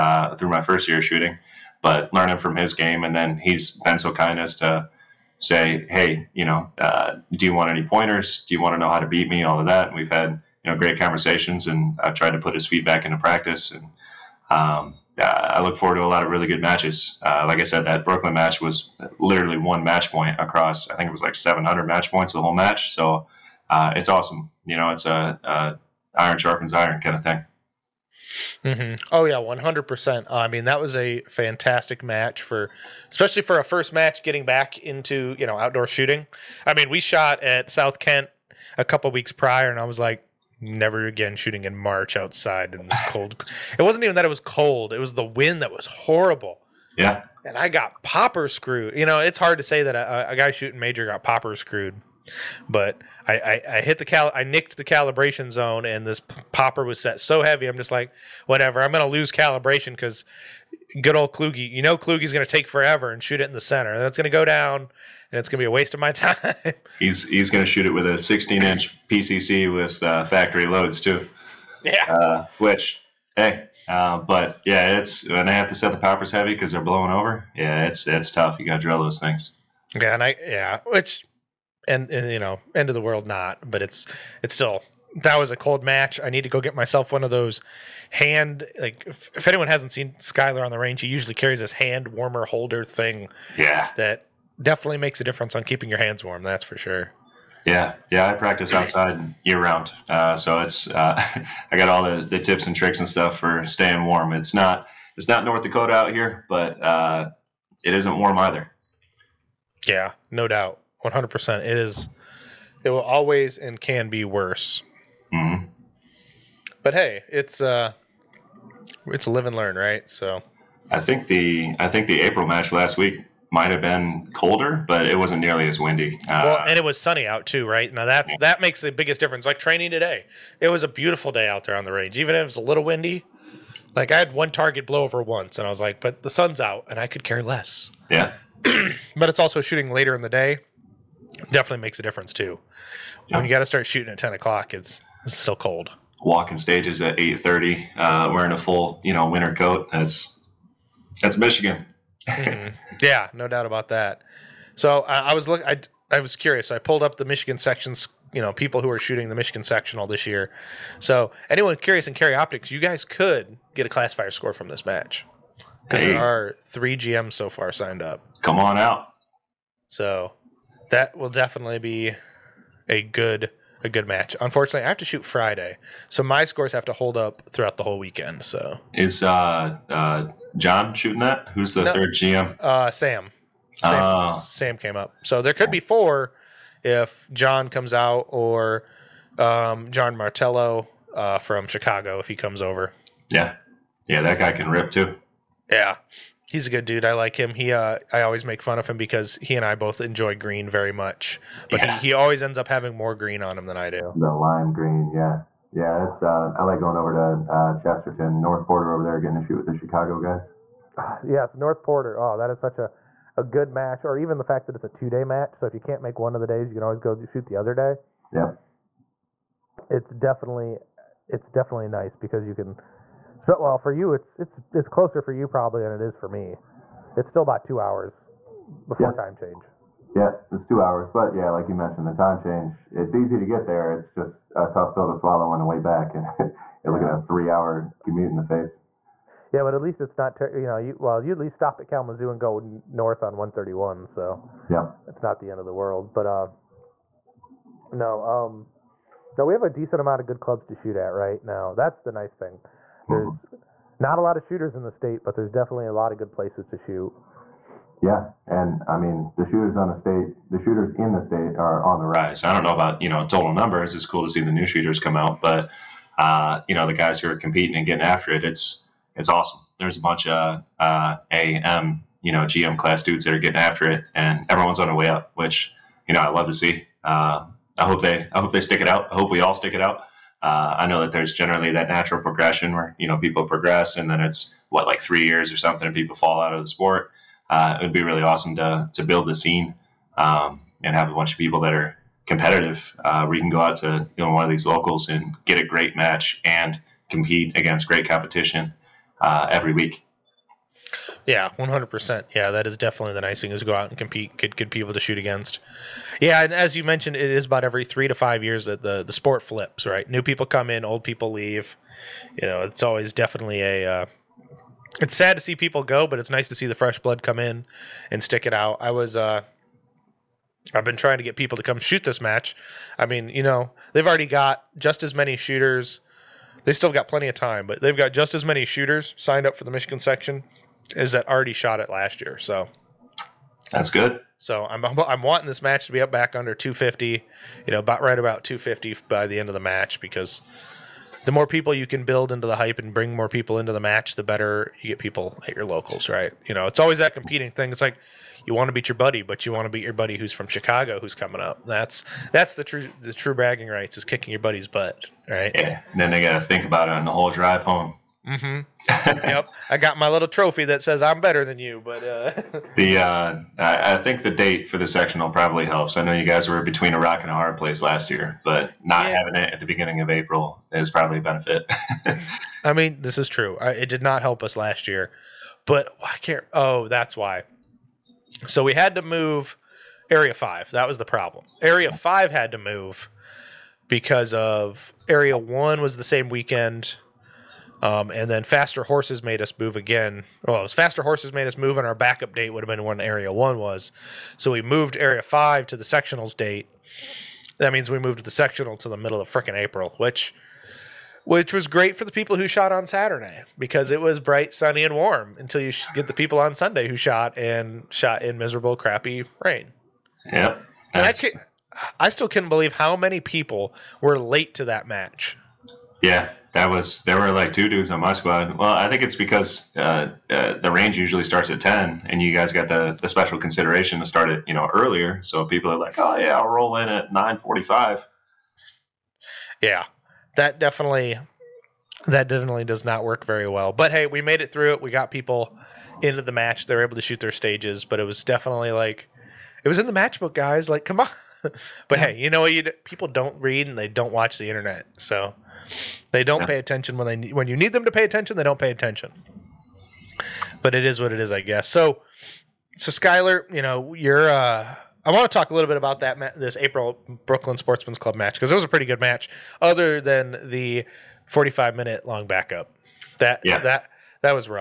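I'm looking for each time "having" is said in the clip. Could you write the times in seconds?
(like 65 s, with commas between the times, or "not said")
202 s, 369 s.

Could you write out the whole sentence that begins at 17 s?
Uh, like I said, that Brooklyn match was literally one match point across.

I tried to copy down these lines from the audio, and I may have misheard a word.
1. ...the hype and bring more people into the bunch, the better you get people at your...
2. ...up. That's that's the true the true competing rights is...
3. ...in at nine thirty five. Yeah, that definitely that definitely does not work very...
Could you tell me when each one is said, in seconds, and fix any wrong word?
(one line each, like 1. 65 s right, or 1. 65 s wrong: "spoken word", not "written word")
1. 342 s wrong: "match", not "bunch"
2. 351 s wrong: "bragging", not "competing"
3. 426 s wrong: "forty", not "thirty".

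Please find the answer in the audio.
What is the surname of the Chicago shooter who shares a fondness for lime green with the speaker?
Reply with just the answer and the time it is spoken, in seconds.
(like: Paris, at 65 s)
Martello, at 190 s.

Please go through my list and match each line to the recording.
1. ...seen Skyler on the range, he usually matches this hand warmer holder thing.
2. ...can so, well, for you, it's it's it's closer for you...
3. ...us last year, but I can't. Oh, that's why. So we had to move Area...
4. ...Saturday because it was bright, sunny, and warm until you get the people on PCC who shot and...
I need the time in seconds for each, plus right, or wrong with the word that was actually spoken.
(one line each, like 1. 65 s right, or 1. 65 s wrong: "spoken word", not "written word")
1. 89 s wrong: "carries", not "matches"
2. 222 s right
3. 374 s right
4. 402 s wrong: "Sunday", not "PCC".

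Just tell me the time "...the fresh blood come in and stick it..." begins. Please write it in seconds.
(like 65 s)
316 s.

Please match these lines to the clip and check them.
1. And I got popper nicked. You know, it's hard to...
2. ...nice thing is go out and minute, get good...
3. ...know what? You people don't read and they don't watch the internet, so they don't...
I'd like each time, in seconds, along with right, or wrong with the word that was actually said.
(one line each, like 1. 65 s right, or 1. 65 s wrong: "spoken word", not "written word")
1. 47 s wrong: "screwed", not "nicked"
2. 303 s wrong: "compete", not "minute"
3. 442 s right.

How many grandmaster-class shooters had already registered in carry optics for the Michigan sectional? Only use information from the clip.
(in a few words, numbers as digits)
3.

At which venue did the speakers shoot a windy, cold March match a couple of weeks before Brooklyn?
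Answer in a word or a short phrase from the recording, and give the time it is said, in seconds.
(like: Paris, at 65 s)
South Kent, at 37 s.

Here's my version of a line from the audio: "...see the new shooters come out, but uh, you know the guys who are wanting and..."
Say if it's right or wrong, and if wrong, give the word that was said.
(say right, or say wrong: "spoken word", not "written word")
wrong: "competing", not "wanting".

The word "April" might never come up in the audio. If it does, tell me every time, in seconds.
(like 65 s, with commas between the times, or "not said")
122 s, 370 s, 399 s, 456 s.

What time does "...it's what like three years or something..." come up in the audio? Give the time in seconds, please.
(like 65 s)
284 s.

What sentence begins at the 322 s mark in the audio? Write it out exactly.
I mean, you know, they've already got just as many shooters.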